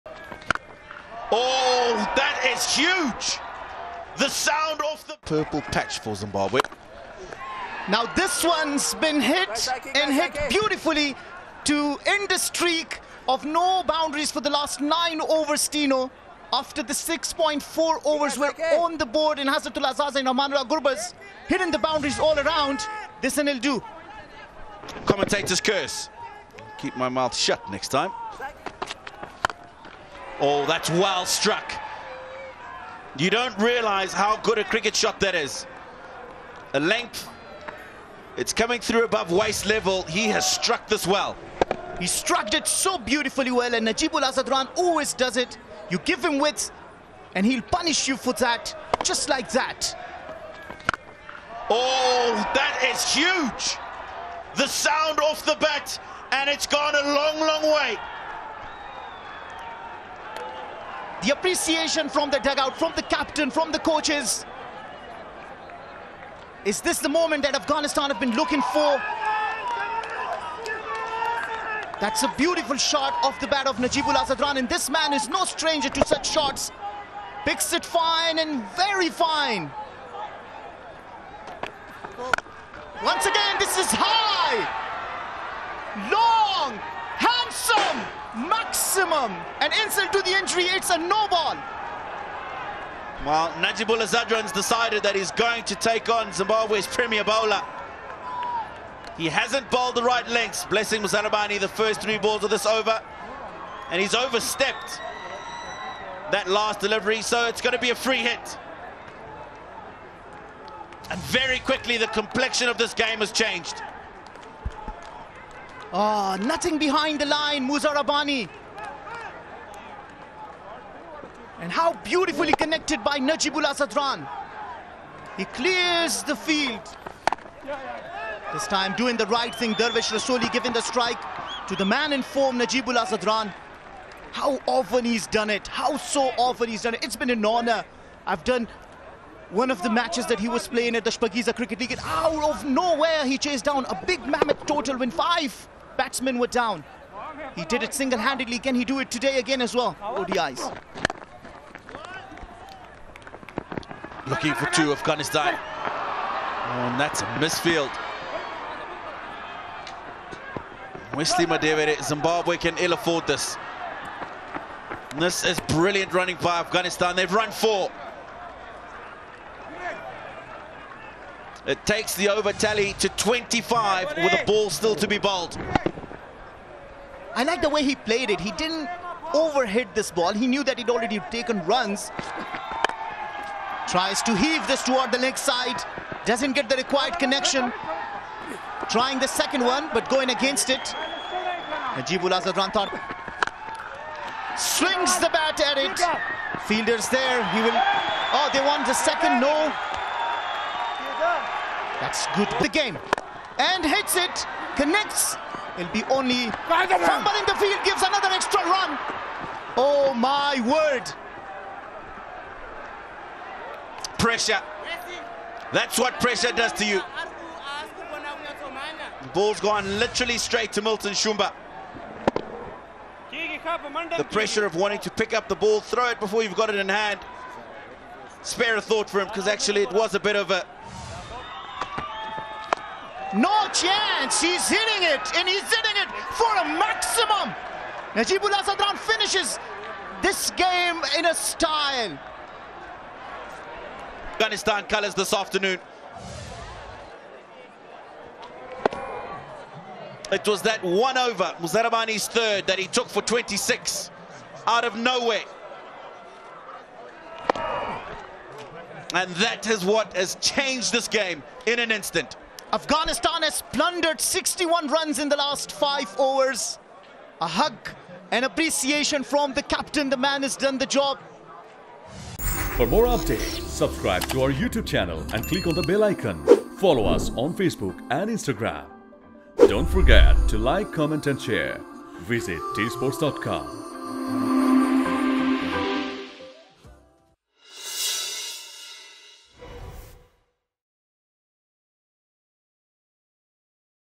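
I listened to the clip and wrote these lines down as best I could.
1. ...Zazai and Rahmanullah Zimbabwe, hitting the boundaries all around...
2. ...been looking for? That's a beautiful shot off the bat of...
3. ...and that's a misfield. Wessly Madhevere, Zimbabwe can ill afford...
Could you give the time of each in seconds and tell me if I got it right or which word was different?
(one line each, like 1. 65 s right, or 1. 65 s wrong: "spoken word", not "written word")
1. 19 s wrong: "Gurbaz", not "Zimbabwe"
2. 68 s right
3. 156 s right.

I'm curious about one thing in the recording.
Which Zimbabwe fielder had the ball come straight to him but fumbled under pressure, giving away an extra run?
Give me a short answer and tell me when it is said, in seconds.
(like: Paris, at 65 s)
Milton Shumba, at 220 s.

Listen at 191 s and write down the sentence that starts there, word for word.
Najibul Azadranthar swings the bat at it.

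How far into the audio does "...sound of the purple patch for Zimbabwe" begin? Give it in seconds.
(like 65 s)
4 s.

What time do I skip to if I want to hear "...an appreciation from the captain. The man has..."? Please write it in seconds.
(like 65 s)
268 s.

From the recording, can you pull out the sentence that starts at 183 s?
Tries to heave this toward the leg side.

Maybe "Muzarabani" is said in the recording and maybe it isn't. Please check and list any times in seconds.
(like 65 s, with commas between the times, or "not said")
101 s, 117 s, 251 s.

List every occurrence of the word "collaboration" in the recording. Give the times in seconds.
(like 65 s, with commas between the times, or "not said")
not said.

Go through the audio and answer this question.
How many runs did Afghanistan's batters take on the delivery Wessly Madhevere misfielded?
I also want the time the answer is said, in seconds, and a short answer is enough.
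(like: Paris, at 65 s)
4, at 167 s.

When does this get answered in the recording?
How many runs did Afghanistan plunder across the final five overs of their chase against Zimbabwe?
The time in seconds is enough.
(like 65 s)
264 s.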